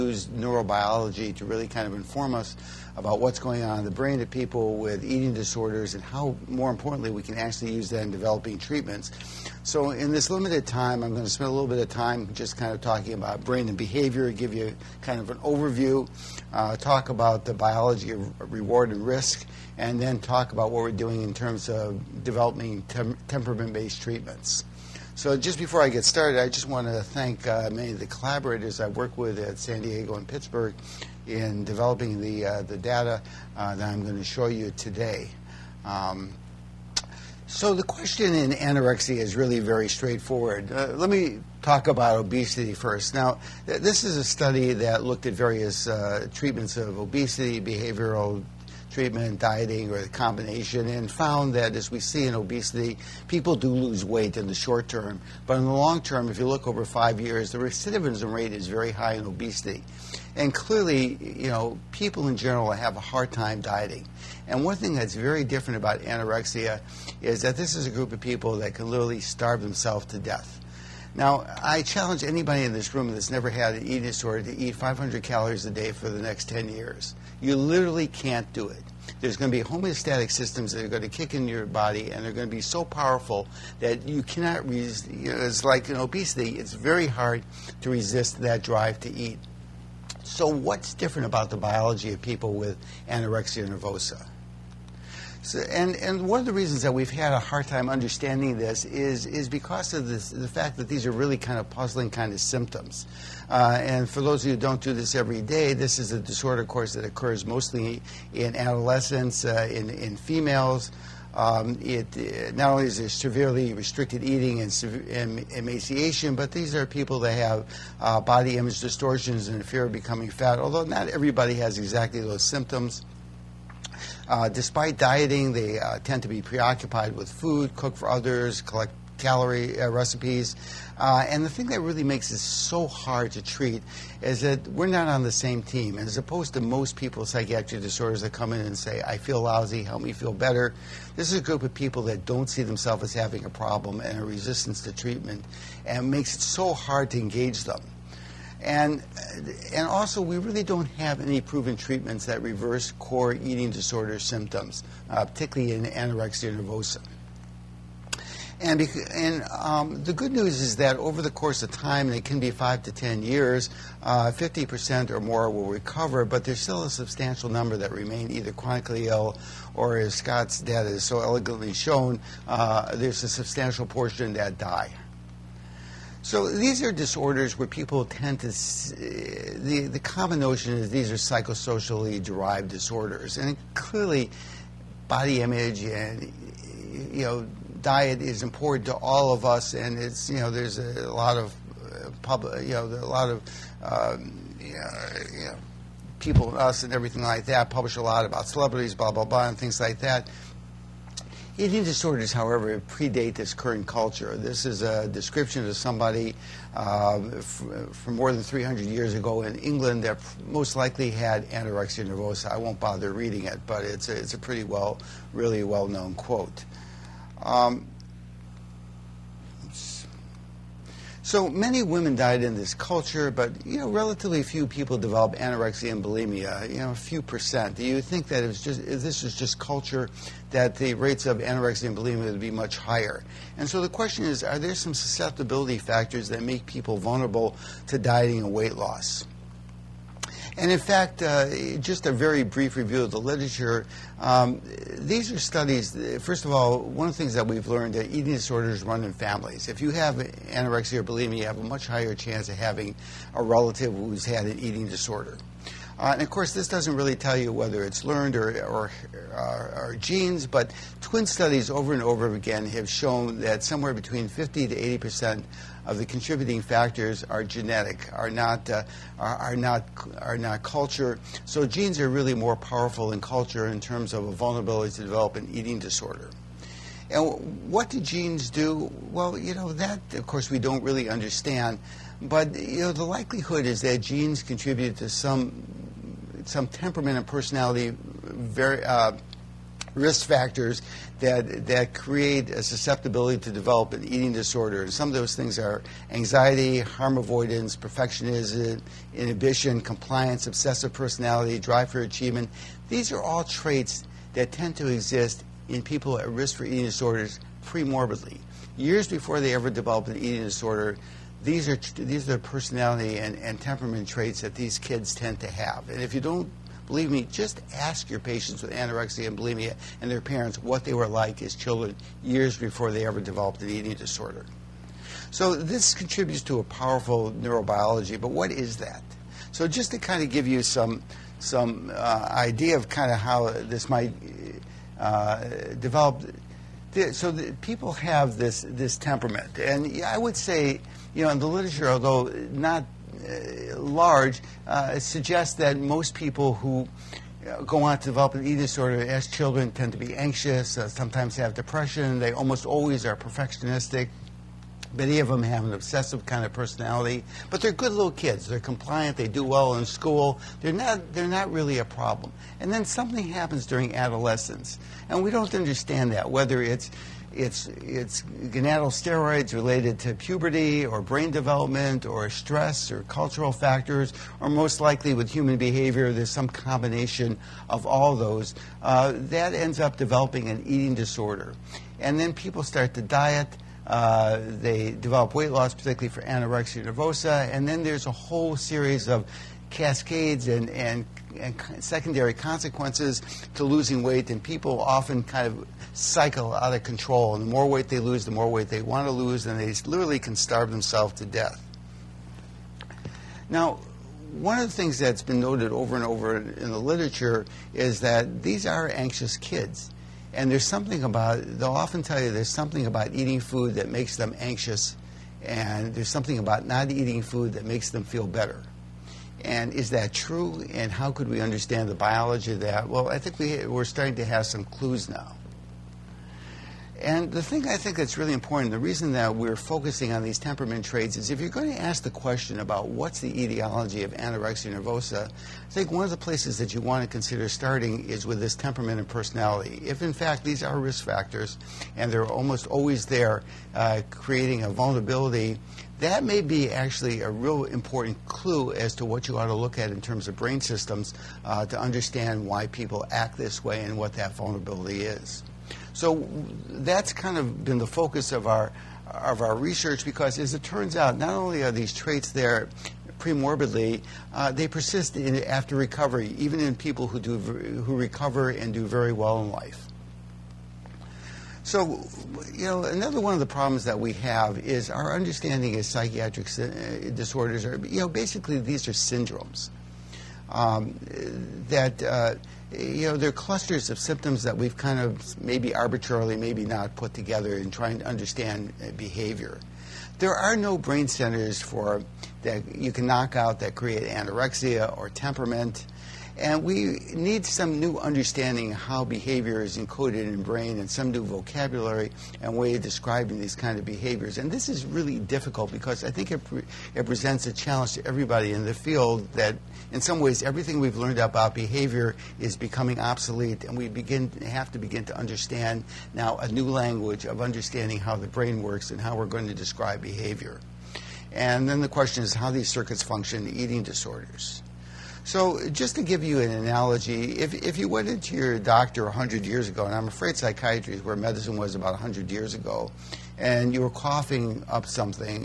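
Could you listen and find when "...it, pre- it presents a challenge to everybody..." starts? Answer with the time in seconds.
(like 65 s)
506 s.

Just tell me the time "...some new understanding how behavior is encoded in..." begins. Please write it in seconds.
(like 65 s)
497 s.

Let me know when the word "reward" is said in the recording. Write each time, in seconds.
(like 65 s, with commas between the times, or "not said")
18 s.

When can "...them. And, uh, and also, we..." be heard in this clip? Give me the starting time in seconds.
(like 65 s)
147 s.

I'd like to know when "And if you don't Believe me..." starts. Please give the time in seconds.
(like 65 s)
315 s.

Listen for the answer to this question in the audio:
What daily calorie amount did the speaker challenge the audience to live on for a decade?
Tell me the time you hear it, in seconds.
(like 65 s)
74 s.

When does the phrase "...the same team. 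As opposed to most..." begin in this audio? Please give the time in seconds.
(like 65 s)
135 s.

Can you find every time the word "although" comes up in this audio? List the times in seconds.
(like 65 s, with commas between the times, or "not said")
120 s, 341 s.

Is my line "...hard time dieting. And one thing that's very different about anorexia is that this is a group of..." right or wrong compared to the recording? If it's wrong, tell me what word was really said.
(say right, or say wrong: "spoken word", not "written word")
right.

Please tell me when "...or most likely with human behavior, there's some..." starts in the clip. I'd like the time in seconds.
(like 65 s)
374 s.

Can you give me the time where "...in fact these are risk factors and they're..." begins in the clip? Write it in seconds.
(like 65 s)
440 s.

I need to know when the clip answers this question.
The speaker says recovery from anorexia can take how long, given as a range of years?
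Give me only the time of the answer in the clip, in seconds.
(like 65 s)
162 s.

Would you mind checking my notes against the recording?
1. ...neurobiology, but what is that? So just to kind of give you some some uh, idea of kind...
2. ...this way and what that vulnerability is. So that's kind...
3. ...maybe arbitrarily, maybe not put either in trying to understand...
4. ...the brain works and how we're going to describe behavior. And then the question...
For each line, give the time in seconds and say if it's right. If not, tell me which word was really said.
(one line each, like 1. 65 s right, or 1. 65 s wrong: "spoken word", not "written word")
1. 327 s right
2. 453 s right
3. 485 s wrong: "together", not "either"
4. 518 s right.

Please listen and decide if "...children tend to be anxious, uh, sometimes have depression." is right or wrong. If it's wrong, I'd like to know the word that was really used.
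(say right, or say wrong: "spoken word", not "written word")
right.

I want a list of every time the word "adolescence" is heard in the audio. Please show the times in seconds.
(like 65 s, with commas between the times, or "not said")
108 s, 363 s.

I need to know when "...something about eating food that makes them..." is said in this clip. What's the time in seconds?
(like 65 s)
412 s.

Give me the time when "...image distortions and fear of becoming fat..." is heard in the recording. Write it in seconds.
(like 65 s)
118 s.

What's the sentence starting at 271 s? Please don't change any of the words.
So genes are really more powerful than culture in terms of a vulnerability to develop an eating disorder.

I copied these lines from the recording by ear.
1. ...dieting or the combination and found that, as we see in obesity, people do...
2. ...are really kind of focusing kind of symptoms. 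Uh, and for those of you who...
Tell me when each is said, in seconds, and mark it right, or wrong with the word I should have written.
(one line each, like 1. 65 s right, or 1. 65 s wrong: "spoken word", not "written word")
1. 49 s right
2. 101 s wrong: "puzzling", not "focusing".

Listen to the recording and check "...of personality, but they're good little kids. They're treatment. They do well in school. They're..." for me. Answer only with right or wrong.
wrong.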